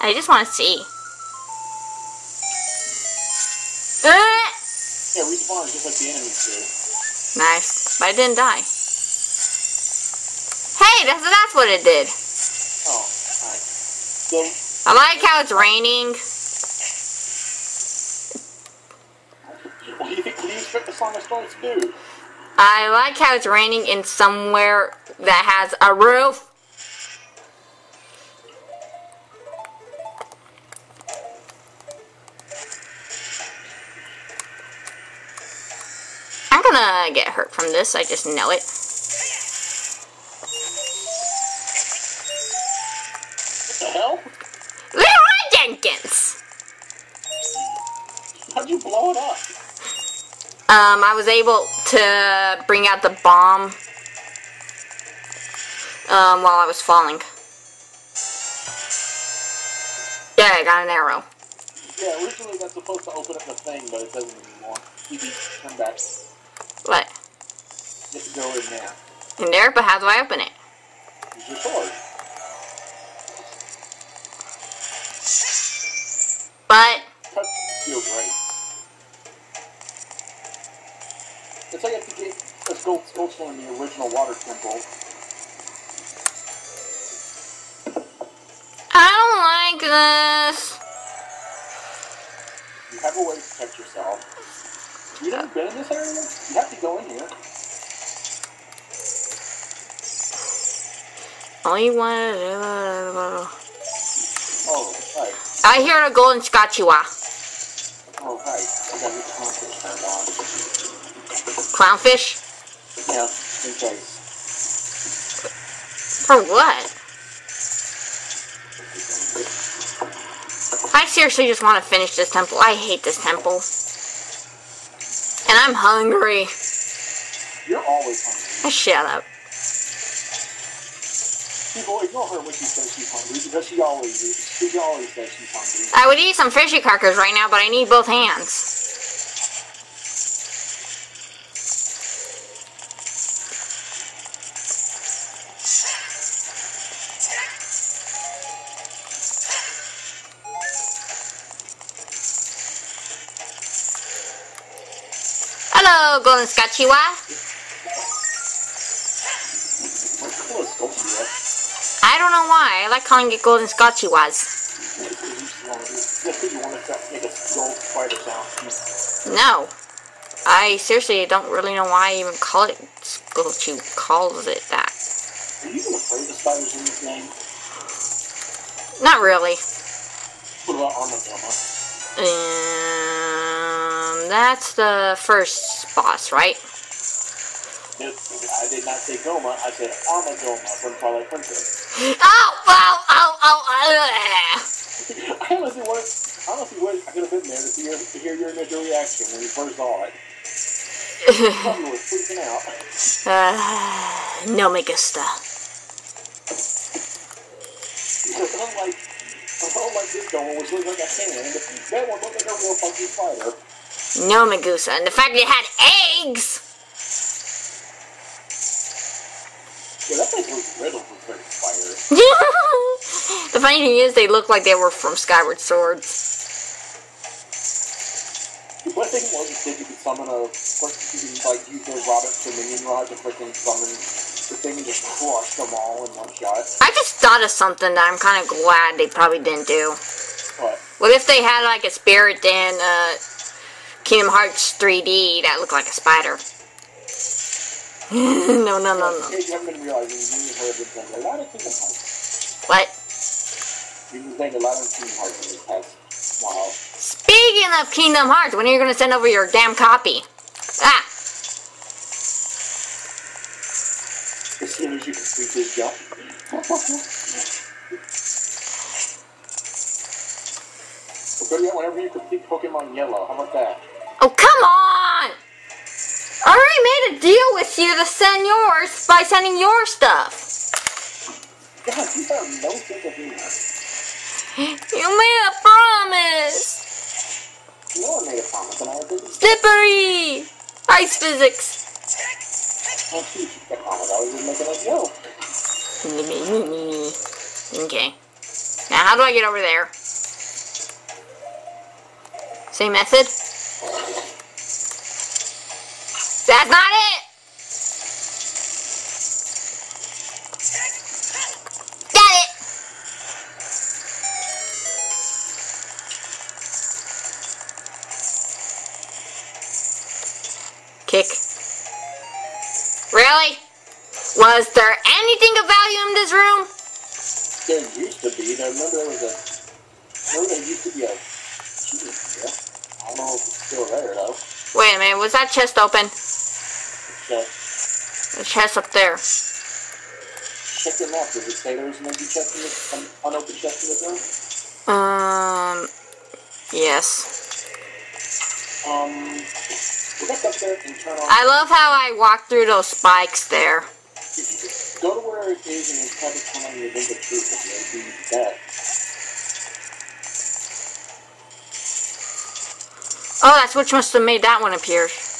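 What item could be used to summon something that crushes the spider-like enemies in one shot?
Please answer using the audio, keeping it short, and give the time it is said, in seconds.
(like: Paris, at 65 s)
Dominion Rod, at 232 s.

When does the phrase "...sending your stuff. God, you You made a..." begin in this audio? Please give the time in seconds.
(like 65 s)
279 s.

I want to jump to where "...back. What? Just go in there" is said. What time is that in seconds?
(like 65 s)
65 s.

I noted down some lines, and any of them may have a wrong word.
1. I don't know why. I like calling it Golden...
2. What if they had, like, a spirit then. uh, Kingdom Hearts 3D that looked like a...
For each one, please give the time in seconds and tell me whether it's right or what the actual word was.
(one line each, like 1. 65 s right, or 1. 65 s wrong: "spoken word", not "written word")
1. 162 s right
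2. 241 s right.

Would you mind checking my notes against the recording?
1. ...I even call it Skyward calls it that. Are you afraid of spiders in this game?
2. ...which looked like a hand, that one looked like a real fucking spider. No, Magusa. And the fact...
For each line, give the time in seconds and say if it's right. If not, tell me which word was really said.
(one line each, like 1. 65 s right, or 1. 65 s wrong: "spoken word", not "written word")
1. 172 s wrong: "Scorchy", not "Skyward"
2. 210 s right.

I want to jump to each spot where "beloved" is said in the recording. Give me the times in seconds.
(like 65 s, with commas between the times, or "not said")
not said.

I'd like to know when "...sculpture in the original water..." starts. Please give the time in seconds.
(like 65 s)
82 s.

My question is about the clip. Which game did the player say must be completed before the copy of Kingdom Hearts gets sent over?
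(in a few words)
Pokemon Yellow.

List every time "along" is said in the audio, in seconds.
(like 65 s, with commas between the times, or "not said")
not said.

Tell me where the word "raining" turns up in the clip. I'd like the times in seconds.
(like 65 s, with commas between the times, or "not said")
15 s, 23 s.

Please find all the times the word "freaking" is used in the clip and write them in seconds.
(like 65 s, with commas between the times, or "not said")
201 s, 233 s.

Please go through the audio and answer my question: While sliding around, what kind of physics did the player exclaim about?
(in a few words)
ice physics.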